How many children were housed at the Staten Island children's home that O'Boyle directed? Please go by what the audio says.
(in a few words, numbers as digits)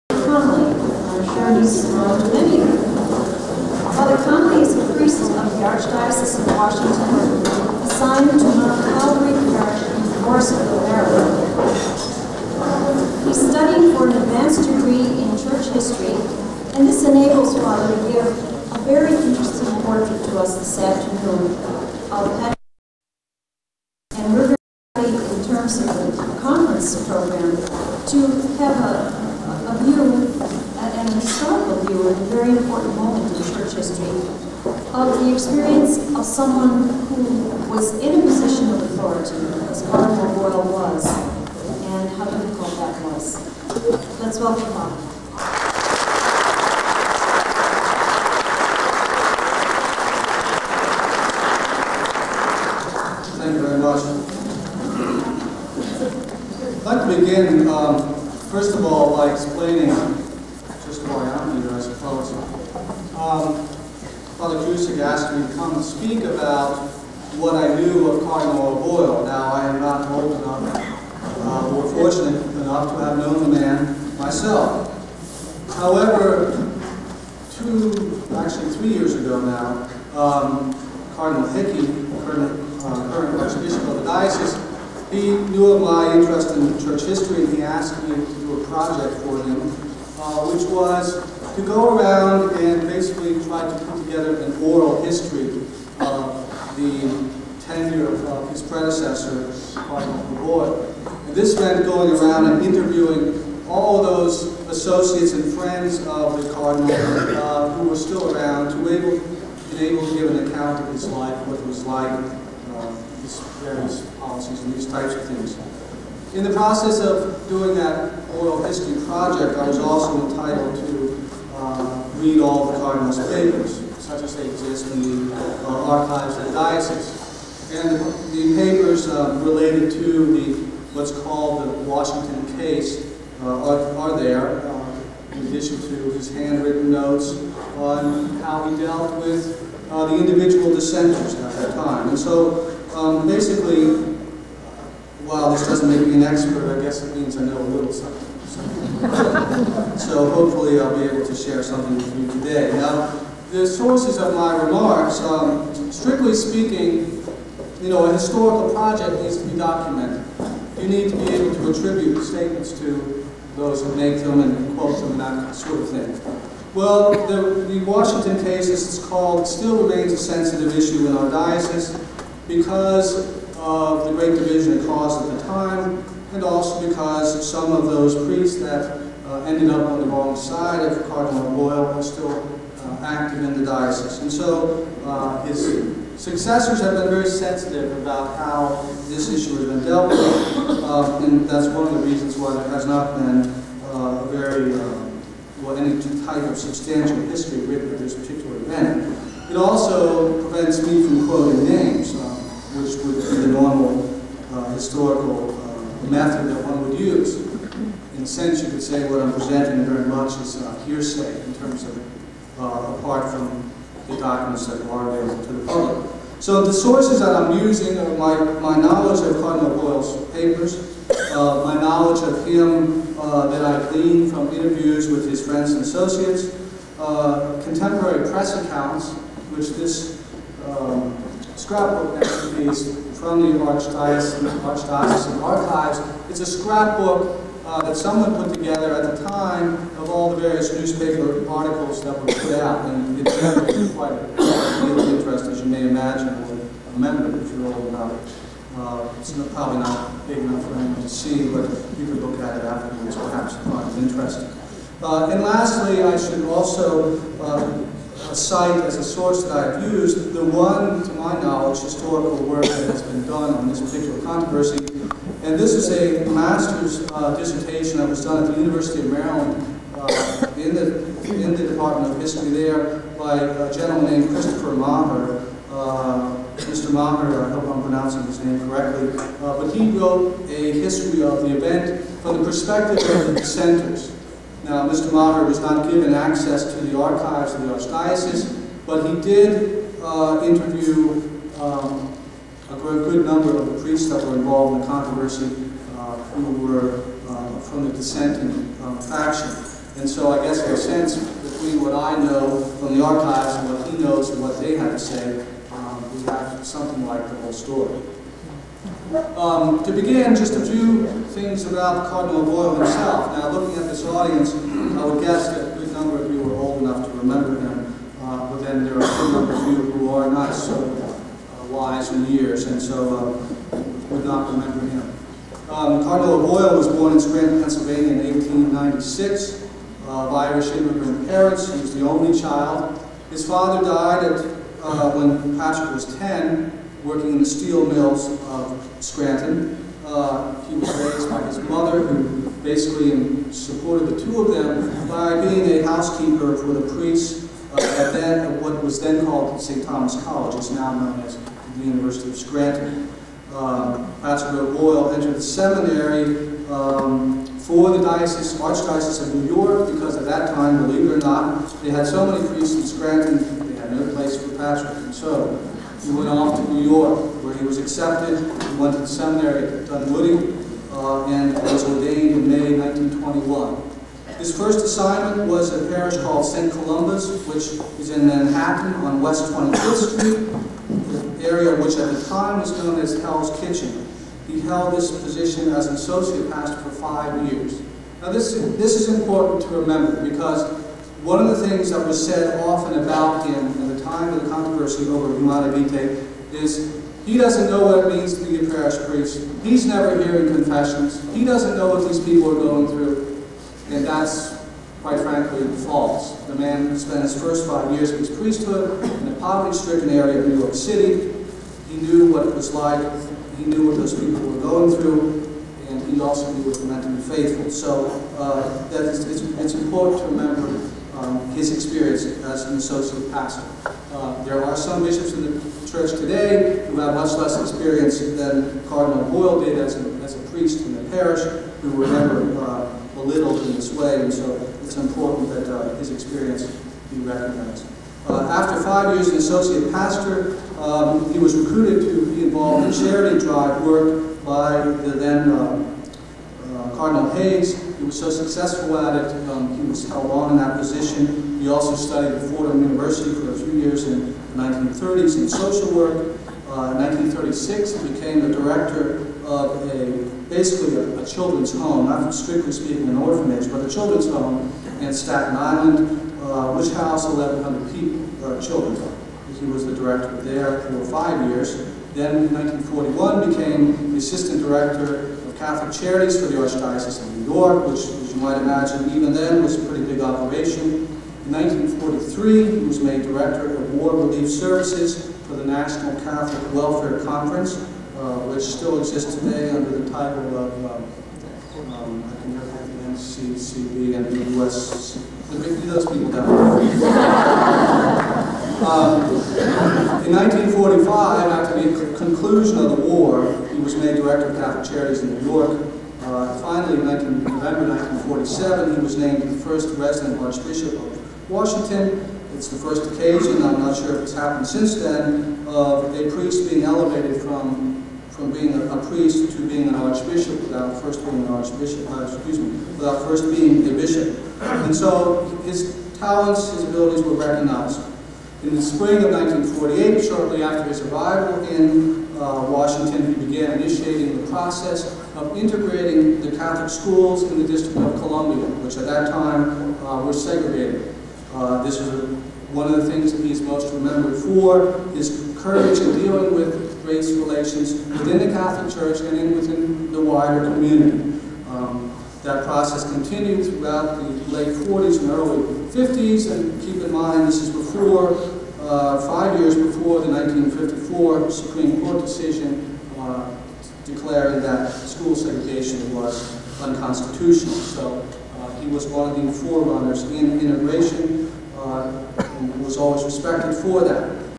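1,100.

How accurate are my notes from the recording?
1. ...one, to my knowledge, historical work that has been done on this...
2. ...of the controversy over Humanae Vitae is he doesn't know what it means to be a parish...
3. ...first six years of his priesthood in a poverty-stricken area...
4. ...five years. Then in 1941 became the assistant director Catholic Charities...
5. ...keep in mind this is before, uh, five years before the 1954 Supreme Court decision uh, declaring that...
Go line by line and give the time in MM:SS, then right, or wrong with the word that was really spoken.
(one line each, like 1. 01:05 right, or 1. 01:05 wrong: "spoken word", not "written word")
1. 04:20 right
2. 06:34 right
3. 06:47 wrong: "five", not "six"
4. 07:51 right
5. 09:16 right.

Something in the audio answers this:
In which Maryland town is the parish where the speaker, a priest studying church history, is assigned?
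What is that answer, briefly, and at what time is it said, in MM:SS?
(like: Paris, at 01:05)
Morrisonville, at 00:10.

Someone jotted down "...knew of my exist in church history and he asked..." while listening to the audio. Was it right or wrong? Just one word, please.
wrong.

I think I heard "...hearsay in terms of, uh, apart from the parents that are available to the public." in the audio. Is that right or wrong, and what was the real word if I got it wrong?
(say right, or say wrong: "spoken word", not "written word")
wrong: "documents", not "parents".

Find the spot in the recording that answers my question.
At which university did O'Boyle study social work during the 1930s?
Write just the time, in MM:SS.
07:32.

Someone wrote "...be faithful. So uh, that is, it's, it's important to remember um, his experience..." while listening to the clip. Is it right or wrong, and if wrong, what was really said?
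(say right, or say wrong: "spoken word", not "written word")
right.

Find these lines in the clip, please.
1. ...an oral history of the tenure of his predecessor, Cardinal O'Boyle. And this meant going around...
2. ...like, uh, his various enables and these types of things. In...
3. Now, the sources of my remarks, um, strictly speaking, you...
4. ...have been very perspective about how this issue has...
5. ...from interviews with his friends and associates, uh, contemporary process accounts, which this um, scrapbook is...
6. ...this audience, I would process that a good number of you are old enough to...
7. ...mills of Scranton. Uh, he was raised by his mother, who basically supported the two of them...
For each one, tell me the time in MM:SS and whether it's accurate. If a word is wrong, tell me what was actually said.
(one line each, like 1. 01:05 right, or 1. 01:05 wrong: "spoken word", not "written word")
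1. 01:34 right
2. 01:51 wrong: "policies", not "enables"
3. 02:32 right
4. 03:06 wrong: "sensitive", not "perspective"
5. 03:44 wrong: "press", not "process"
6. 05:13 wrong: "guess", not "process"
7. 05:37 right.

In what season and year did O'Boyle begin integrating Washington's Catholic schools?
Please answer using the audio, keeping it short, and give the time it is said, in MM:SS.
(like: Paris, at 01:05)
spring of 1948, at 08:48.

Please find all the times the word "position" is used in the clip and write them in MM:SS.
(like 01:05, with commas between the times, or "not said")
00:38, 06:25, 07:30.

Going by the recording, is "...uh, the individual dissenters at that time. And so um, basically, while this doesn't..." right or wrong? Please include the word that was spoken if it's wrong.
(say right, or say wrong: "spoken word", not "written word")
right.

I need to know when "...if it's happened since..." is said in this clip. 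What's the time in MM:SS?
08:34.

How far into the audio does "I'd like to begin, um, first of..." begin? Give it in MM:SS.
00:56.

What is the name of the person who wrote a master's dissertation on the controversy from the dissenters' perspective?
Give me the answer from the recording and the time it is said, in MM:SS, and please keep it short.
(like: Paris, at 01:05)
Christopher Maher, at 04:34.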